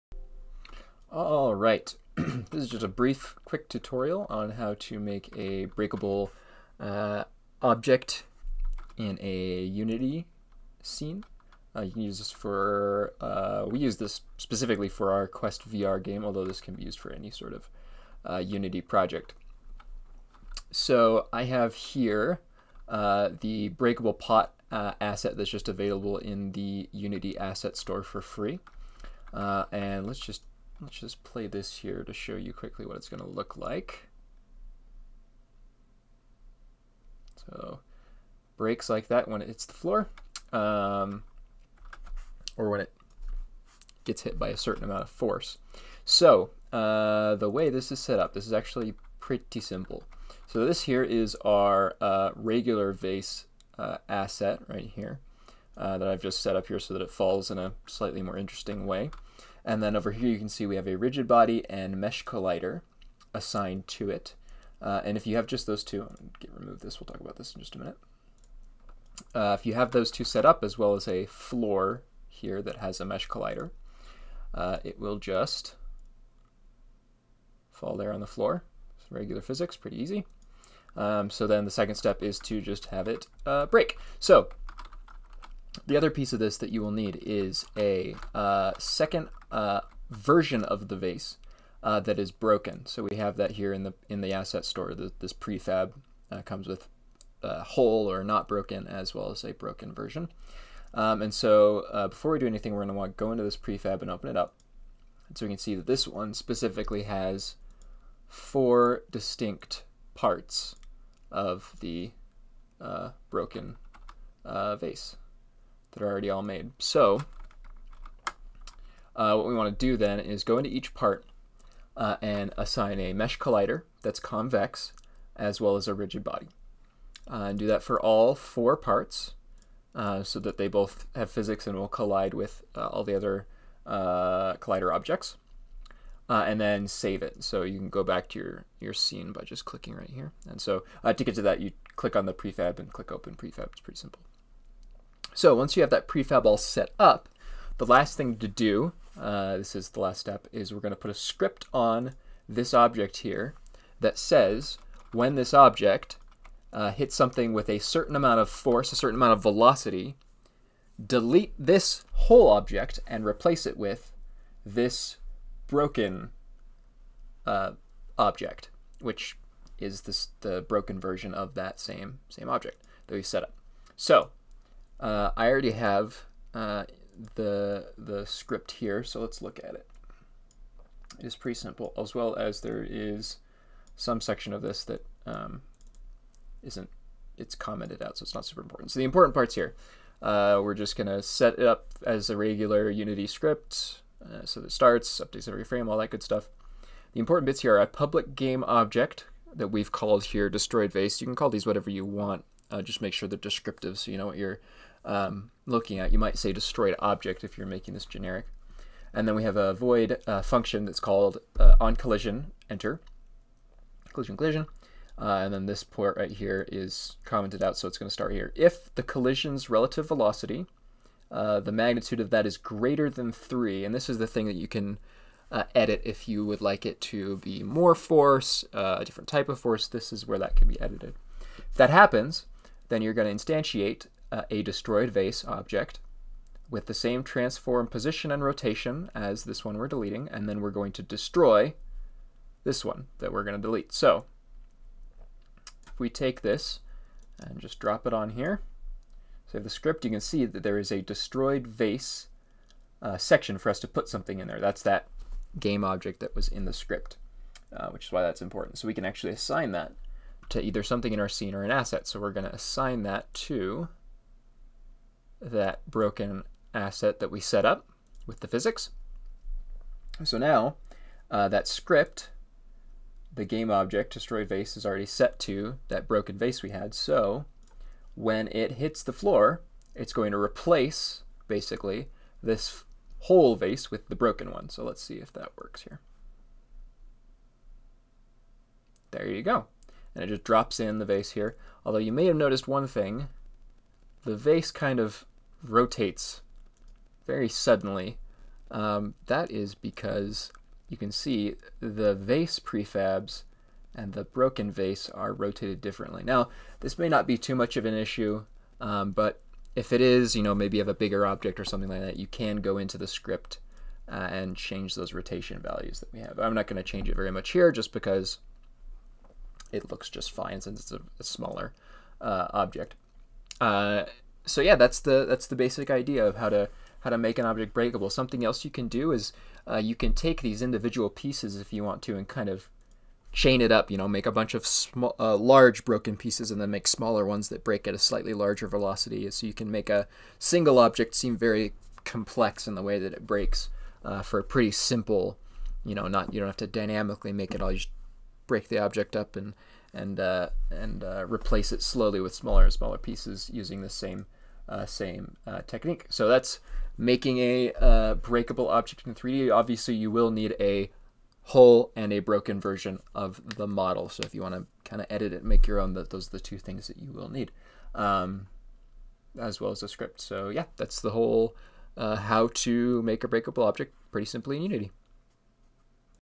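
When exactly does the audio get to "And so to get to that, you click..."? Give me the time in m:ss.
2:20.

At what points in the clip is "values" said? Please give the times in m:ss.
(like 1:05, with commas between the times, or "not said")
5:15.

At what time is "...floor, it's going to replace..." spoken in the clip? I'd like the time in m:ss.
4:39.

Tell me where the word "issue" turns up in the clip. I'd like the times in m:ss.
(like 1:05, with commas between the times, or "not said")
5:07.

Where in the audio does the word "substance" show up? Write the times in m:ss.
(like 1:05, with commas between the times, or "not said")
not said.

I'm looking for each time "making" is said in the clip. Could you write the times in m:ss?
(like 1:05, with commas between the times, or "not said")
3:27, 5:56.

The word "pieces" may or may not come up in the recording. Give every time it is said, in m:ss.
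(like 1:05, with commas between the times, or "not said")
1:26, 5:31, 5:36, 5:52.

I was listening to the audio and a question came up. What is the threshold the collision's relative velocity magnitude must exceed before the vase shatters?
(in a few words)
3.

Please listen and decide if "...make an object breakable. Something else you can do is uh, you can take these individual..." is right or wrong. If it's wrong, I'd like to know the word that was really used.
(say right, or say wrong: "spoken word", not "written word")
right.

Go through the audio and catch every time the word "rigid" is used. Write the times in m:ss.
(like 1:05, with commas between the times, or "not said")
1:00, 2:05.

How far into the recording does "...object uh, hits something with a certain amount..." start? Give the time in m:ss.
2:35.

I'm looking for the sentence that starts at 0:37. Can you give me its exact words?
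So breaks like that when it hits the floor um, or when it gets hit by a certain amount of force.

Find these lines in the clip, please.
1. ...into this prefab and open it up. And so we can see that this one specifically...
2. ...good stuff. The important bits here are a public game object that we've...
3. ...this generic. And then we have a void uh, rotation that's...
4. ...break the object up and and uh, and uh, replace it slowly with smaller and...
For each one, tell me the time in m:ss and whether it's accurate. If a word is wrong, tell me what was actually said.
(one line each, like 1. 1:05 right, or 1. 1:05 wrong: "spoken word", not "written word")
1. 1:43 right
2. 3:16 right
3. 3:27 wrong: "function", not "rotation"
4. 5:48 right.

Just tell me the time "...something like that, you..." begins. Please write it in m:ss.
5:11.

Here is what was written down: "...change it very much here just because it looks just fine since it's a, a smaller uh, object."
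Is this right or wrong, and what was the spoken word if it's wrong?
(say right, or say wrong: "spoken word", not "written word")
right.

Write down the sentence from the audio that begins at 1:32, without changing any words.
So we have that here in the in the asset store.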